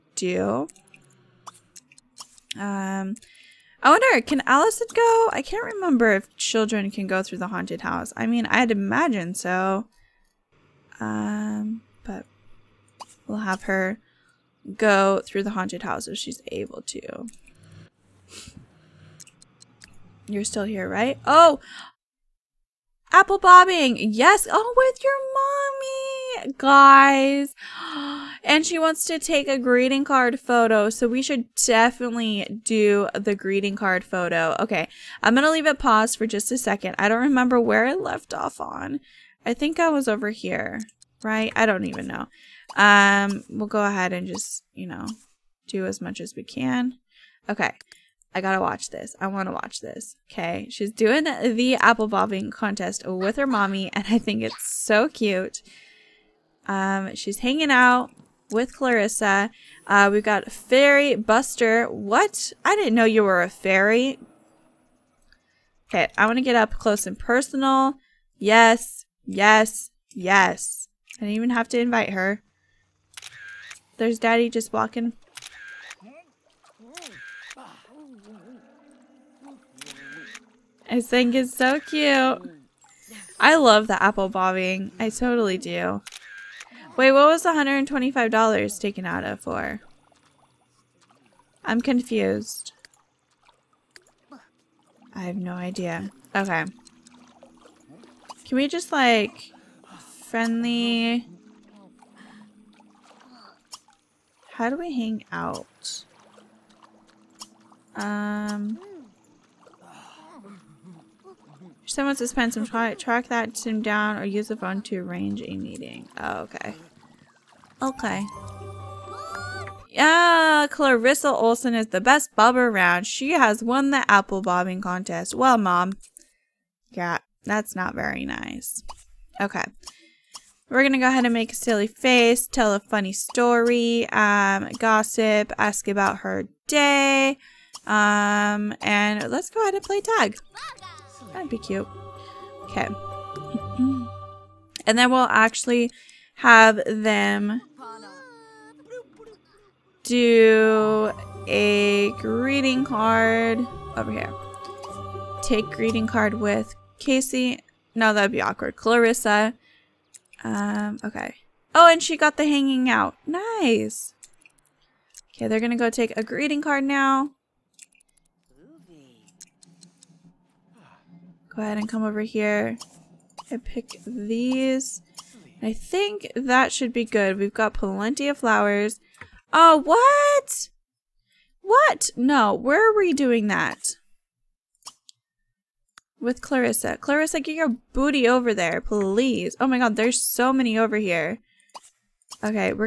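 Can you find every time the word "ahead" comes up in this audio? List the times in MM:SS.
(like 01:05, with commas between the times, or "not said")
00:43, 02:11, 02:19, 02:51.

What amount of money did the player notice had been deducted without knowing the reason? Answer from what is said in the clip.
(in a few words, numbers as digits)
$125.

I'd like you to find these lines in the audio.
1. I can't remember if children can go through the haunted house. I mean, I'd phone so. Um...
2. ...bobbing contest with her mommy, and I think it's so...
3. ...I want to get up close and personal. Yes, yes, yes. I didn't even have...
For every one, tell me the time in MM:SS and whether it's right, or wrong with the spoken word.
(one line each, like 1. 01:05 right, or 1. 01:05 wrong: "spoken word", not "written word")
1. 00:05 wrong: "imagine", not "phone"
2. 00:52 right
3. 01:06 right.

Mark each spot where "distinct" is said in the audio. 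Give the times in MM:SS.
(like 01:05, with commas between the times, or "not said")
not said.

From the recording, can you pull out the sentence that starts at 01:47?
Um, someone spend some try track that sim down or use the phone to arrange a meeting.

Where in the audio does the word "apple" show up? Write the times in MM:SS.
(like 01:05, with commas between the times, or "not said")
00:23, 00:51, 01:24, 02:04.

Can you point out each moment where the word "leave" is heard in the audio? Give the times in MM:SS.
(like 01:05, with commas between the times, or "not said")
00:35.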